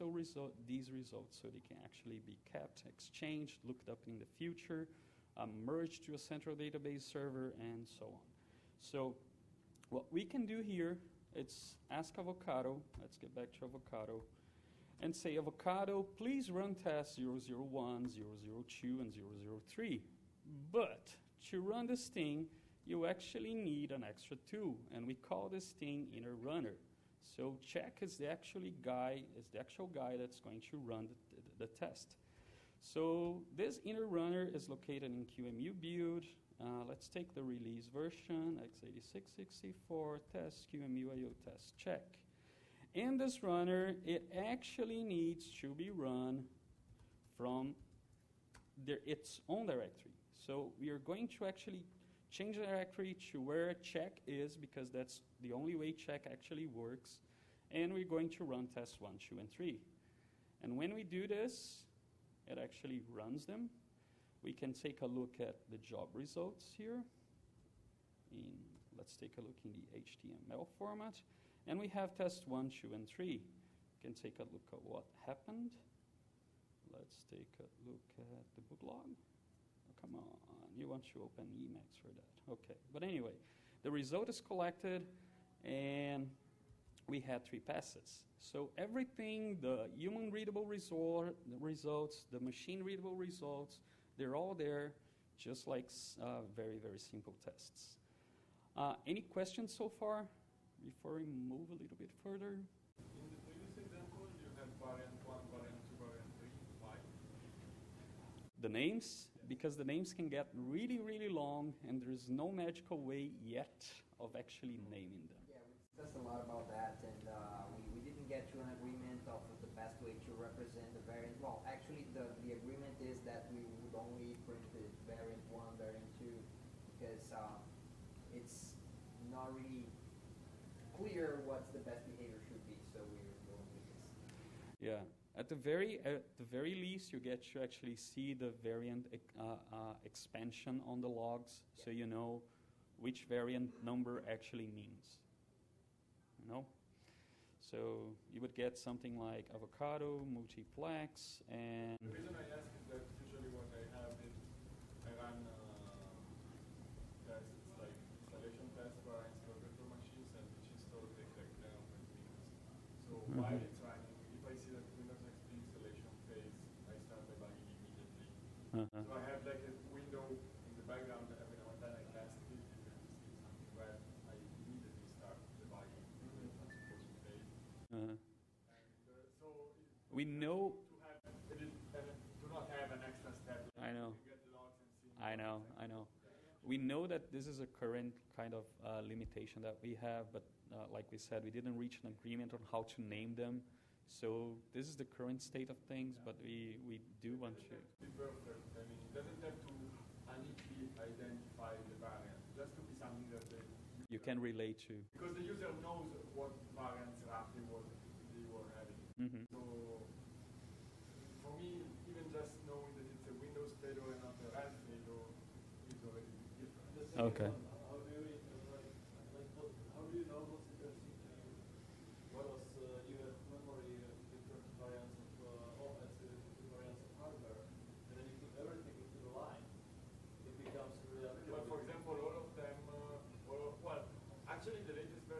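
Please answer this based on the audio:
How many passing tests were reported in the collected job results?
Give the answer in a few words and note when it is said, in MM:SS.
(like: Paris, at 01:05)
3, at 01:27.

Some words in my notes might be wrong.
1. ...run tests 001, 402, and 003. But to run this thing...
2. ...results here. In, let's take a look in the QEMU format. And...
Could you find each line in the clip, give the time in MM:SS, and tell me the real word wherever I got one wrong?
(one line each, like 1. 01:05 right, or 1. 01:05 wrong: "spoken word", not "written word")
1. 00:16 wrong: "002", not "402"
2. 01:06 wrong: "HTML", not "QEMU".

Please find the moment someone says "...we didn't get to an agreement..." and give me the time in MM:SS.
01:57.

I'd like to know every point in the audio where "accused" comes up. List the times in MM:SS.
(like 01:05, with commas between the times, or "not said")
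not said.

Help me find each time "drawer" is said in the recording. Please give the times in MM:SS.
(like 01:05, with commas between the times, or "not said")
not said.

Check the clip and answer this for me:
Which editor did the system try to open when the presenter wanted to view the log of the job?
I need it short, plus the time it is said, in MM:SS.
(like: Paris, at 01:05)
Emacs, at 01:21.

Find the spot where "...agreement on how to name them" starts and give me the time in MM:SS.
03:12.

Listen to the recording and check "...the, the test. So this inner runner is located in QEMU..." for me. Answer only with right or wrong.
right.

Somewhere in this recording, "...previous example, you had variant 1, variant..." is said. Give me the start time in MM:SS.
01:43.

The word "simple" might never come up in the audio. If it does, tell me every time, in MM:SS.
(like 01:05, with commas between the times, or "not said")
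01:36.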